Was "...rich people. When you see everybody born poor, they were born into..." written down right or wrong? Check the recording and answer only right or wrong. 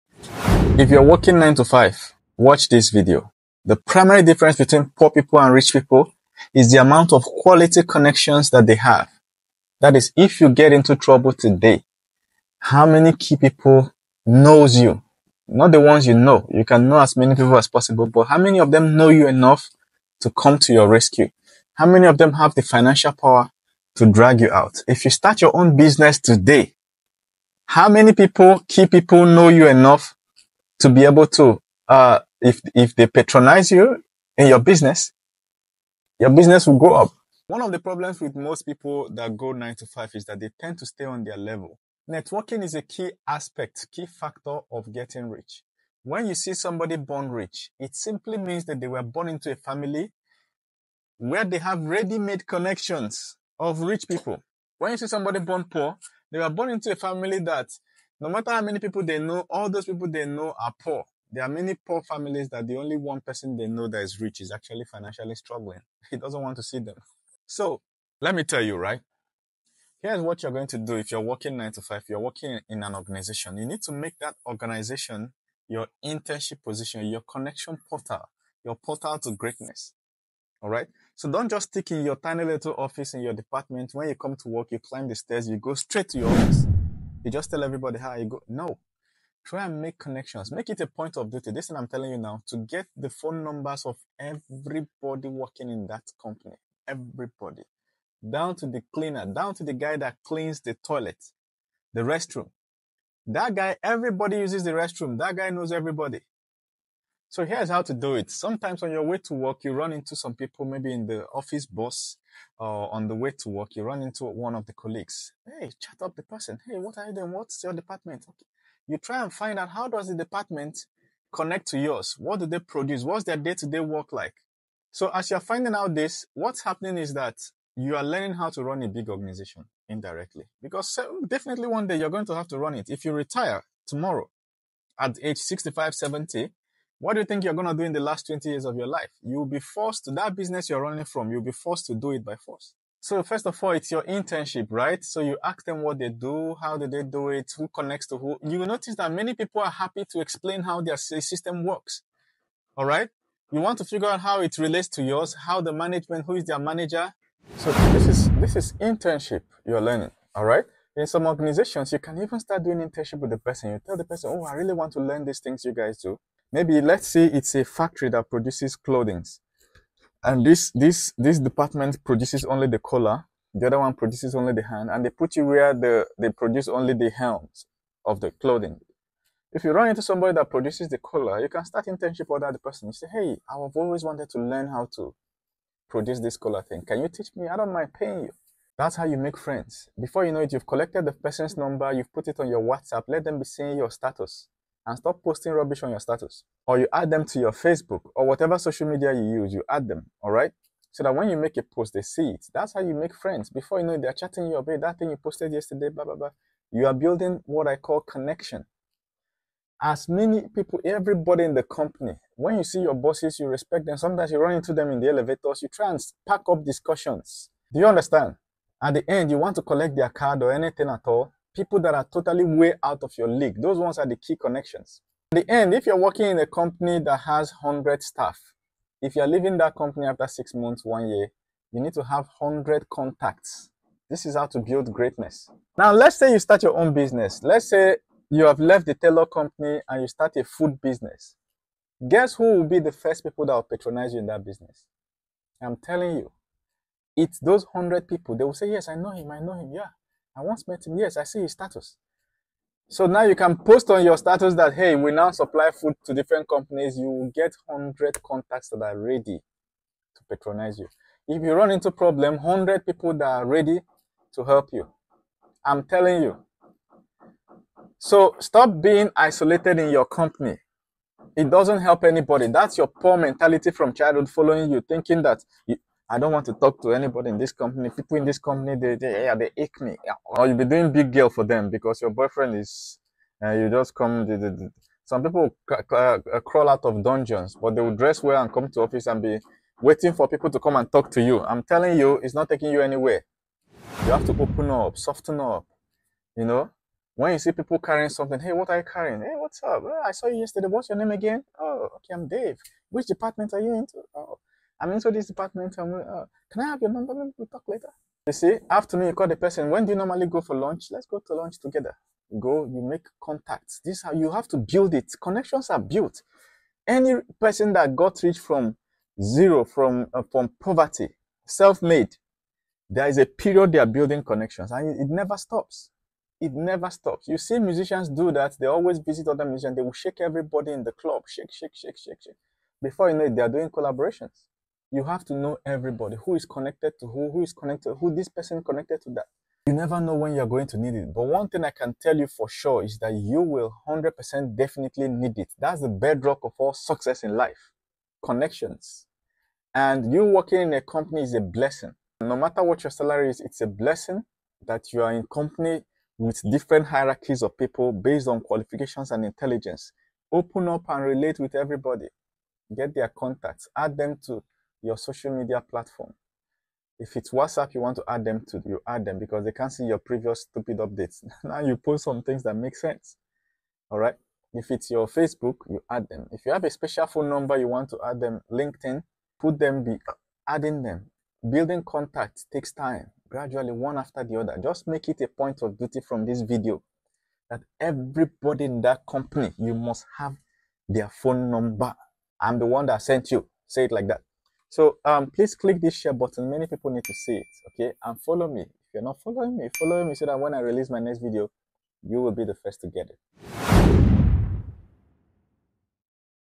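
wrong.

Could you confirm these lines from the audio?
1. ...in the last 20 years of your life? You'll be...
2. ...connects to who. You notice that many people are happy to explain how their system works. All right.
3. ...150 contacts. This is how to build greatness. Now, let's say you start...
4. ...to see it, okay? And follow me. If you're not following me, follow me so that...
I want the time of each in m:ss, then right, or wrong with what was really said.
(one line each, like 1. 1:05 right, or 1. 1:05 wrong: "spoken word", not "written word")
1. 2:17 right
2. 2:27 right
3. 3:52 wrong: "100", not "150"
4. 6:37 right.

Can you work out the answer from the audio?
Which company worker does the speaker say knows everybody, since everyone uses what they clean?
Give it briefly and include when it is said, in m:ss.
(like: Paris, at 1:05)
the guy that cleans the toilet, at 1:39.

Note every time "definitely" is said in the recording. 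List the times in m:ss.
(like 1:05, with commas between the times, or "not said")
2:11, 5:44.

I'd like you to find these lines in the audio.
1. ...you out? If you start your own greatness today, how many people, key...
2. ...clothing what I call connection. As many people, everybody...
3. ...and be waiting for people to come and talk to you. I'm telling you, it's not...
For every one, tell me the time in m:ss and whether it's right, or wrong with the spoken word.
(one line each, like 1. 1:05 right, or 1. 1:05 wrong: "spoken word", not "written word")
1. 0:24 wrong: "business", not "greatness"
2. 3:26 wrong: "building", not "clothing"
3. 4:49 right.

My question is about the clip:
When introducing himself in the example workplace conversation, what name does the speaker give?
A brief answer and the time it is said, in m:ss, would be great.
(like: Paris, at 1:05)
Dave, at 5:02.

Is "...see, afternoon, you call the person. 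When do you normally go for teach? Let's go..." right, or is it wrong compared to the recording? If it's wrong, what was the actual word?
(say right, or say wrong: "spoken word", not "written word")
wrong: "lunch", not "teach".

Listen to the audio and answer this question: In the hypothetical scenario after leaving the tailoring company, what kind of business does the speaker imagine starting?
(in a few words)
food business.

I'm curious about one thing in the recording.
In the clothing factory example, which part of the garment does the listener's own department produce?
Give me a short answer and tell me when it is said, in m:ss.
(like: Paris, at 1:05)
helms, at 2:57.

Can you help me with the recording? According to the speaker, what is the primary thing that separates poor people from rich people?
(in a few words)
quality connections.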